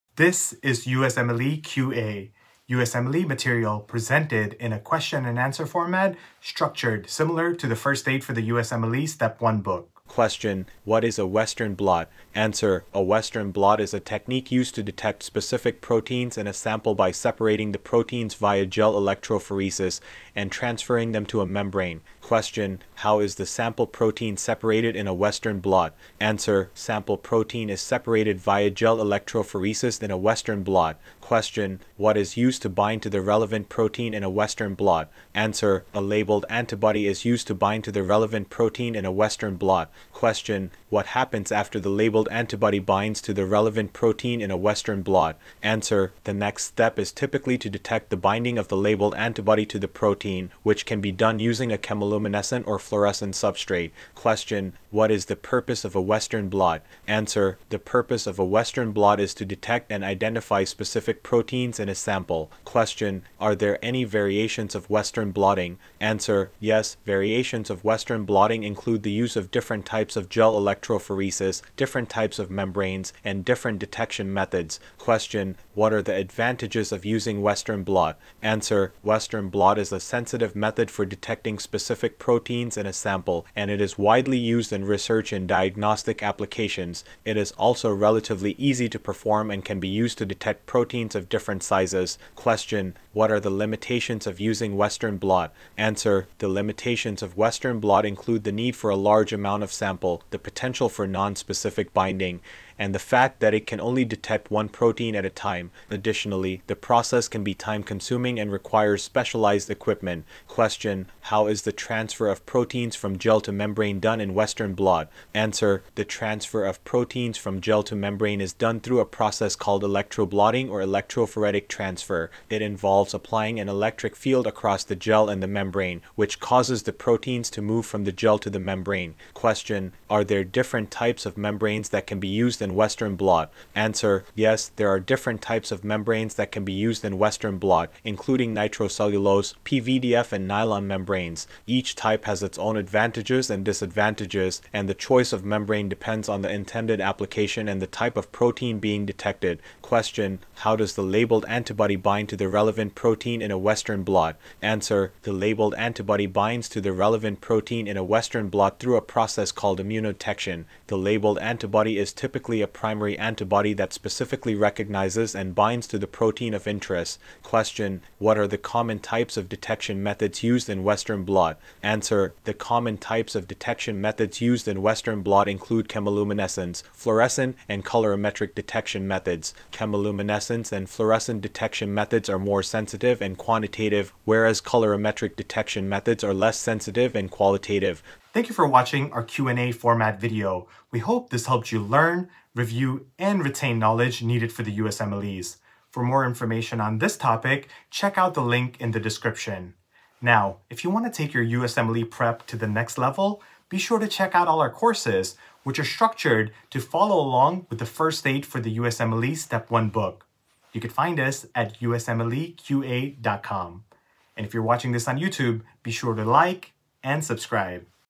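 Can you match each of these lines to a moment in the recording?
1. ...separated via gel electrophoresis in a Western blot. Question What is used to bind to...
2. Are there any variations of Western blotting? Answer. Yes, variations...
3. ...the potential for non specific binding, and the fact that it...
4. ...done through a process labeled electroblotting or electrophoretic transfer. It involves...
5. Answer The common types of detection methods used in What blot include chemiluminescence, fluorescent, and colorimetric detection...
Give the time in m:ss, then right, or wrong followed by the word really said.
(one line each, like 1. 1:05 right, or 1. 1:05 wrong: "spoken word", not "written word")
1. 0:27 right
2. 1:03 right
3. 1:40 right
4. 1:58 wrong: "called", not "labeled"
5. 2:51 wrong: "Western", not "What".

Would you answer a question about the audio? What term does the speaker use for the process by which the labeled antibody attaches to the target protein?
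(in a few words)
immunodetection.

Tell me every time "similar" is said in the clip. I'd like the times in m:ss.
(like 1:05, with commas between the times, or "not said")
0:07.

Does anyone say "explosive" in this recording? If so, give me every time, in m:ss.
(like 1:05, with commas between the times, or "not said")
not said.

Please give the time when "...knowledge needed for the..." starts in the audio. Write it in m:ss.
3:13.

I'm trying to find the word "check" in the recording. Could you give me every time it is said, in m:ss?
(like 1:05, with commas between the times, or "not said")
3:17, 3:24.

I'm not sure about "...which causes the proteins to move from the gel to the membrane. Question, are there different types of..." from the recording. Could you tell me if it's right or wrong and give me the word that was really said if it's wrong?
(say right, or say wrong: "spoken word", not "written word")
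right.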